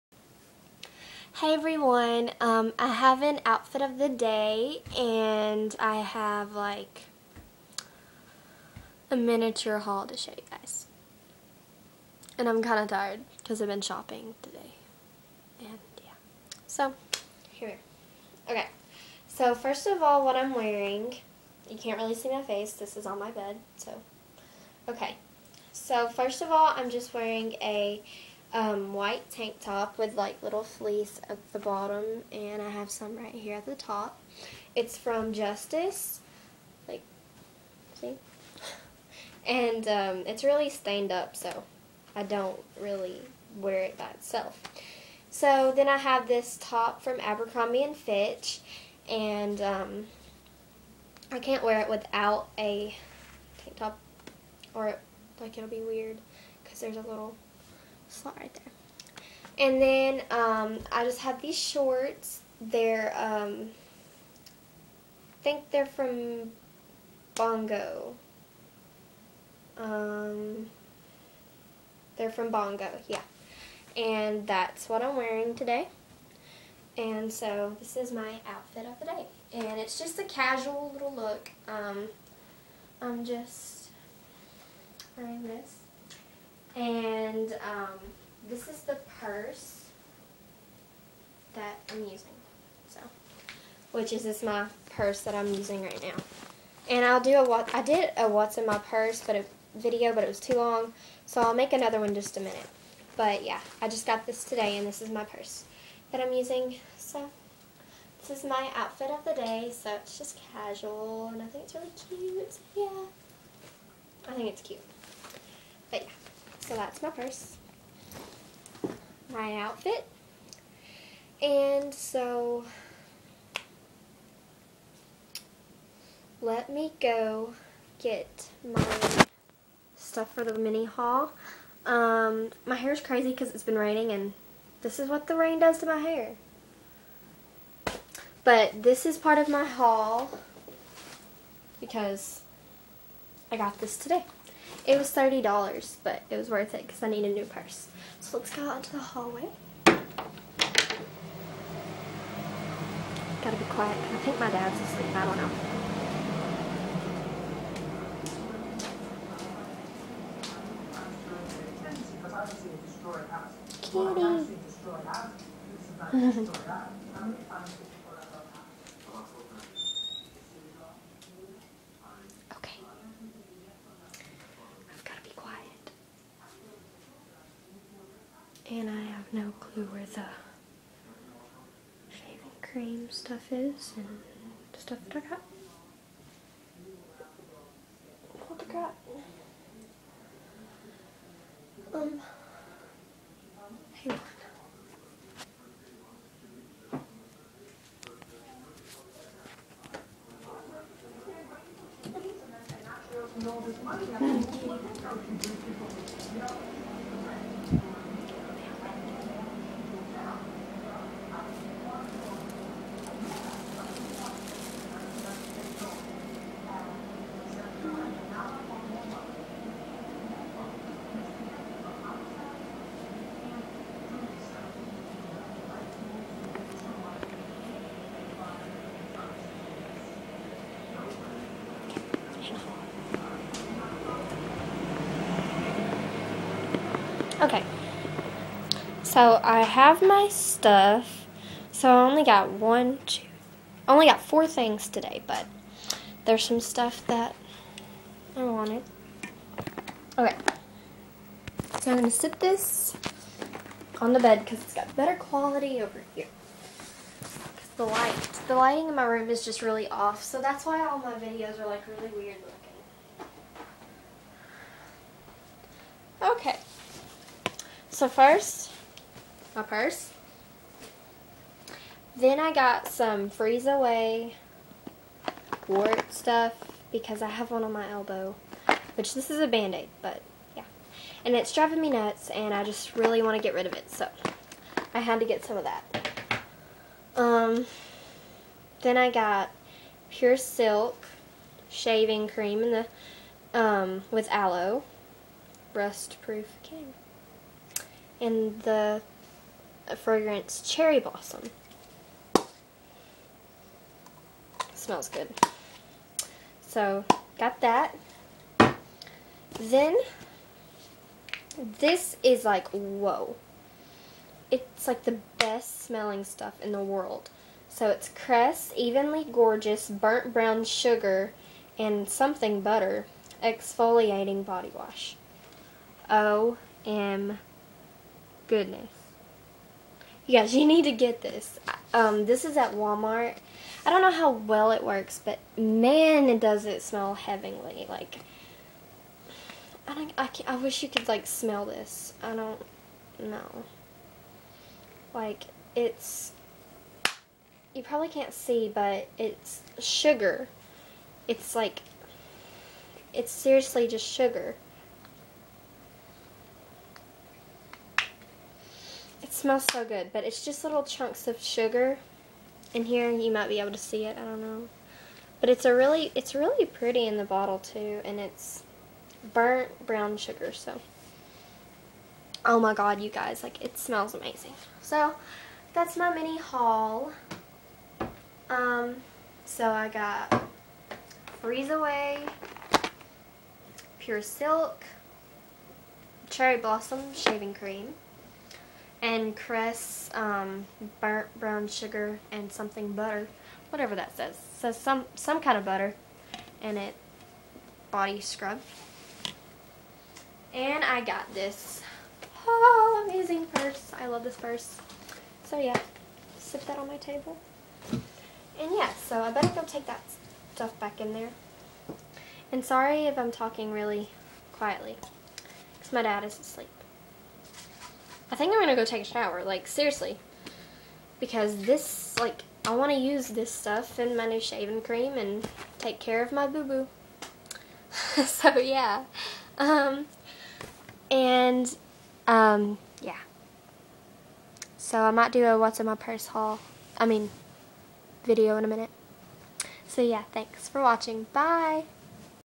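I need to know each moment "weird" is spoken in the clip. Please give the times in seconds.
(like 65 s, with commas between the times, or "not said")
55 s, 262 s.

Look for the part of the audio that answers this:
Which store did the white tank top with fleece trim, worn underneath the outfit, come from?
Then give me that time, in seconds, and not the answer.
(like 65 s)
35 s.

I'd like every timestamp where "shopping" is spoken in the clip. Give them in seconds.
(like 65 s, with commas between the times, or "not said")
13 s.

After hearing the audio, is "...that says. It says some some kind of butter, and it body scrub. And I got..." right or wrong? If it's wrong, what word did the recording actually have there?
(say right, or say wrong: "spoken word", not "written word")
right.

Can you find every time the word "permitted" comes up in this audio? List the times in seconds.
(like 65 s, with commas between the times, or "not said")
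not said.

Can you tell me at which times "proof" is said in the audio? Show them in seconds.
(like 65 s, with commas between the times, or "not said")
295 s.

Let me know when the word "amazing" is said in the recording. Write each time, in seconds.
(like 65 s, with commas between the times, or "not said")
374 s, 403 s.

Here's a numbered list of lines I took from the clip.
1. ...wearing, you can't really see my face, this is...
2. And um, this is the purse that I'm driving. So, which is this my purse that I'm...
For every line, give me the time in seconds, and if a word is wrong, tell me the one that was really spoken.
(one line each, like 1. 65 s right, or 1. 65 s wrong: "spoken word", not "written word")
1. 20 s right
2. 86 s wrong: "using", not "driving".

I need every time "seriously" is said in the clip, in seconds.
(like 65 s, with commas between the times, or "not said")
353 s, 419 s.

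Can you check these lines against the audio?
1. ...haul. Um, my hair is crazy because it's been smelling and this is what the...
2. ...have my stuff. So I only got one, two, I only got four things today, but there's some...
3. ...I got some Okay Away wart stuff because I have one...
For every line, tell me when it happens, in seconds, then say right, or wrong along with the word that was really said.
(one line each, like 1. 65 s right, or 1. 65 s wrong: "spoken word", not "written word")
1. 130 s wrong: "raining", not "smelling"
2. 239 s right
3. 272 s wrong: "Freeze", not "Okay".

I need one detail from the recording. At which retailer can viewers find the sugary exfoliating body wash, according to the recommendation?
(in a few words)
Walmart.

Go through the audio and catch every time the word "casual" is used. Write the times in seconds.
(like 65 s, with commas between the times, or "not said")
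80 s, 110 s.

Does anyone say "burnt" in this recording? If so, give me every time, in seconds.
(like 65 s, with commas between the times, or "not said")
319 s, 369 s, 390 s.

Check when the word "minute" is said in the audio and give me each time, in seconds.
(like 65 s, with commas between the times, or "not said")
102 s, 438 s.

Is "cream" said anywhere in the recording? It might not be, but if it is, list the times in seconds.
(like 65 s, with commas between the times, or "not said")
182 s, 292 s, 296 s, 387 s, 424 s.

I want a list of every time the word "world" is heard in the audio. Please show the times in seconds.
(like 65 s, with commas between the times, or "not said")
316 s.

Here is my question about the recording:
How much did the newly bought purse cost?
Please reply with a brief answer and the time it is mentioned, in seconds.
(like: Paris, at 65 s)
$30, at 145 s.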